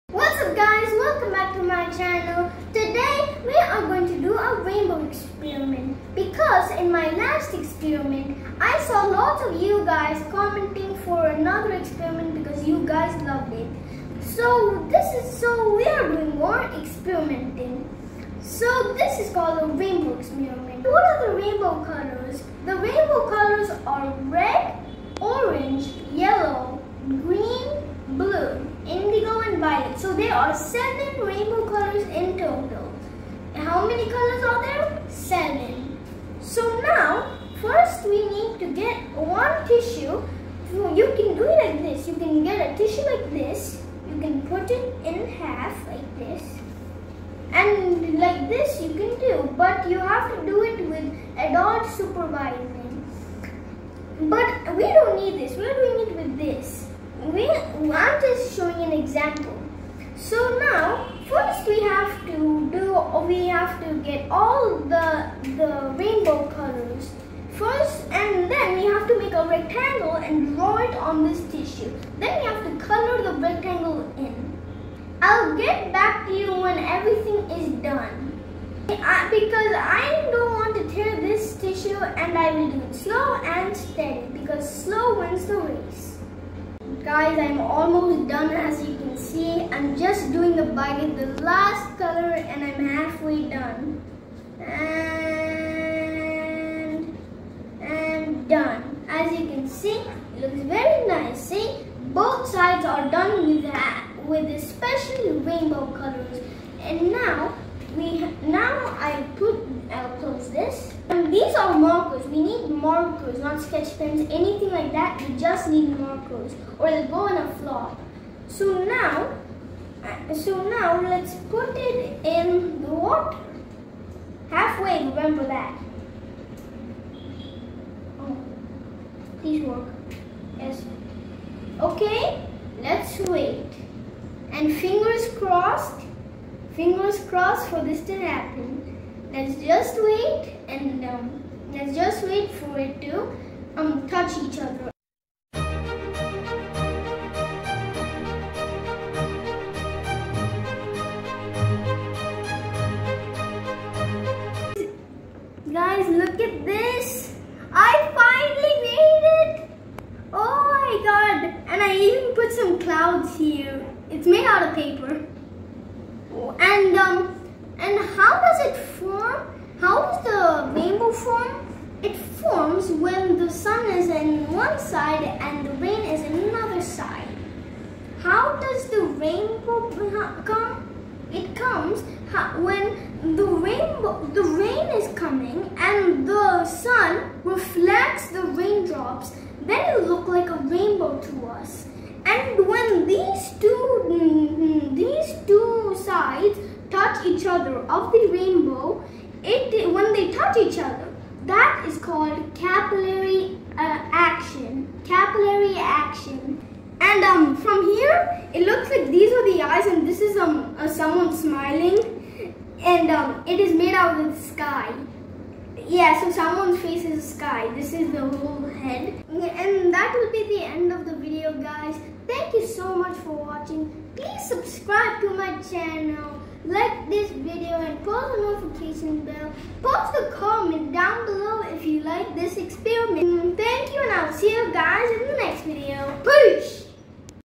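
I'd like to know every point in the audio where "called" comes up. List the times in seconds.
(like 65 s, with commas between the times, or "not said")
19 s, 201 s.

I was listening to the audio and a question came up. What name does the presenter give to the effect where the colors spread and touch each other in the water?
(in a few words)
Capillary action.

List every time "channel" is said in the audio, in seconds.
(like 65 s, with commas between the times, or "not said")
1 s, 225 s.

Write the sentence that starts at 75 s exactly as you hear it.
I'll get back to you when everything is done.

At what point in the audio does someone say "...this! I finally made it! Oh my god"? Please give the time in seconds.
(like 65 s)
156 s.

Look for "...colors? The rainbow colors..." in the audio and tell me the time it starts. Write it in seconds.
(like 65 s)
21 s.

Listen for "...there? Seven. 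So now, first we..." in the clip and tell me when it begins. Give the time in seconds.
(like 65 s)
34 s.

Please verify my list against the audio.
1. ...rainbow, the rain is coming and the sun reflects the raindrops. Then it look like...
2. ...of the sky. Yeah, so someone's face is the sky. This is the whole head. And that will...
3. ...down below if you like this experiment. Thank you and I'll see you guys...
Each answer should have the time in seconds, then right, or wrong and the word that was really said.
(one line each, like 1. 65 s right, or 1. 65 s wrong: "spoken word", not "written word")
1. 183 s right
2. 214 s right
3. 230 s right.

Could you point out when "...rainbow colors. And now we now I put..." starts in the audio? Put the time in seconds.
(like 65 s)
105 s.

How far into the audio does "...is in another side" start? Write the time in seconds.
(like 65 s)
176 s.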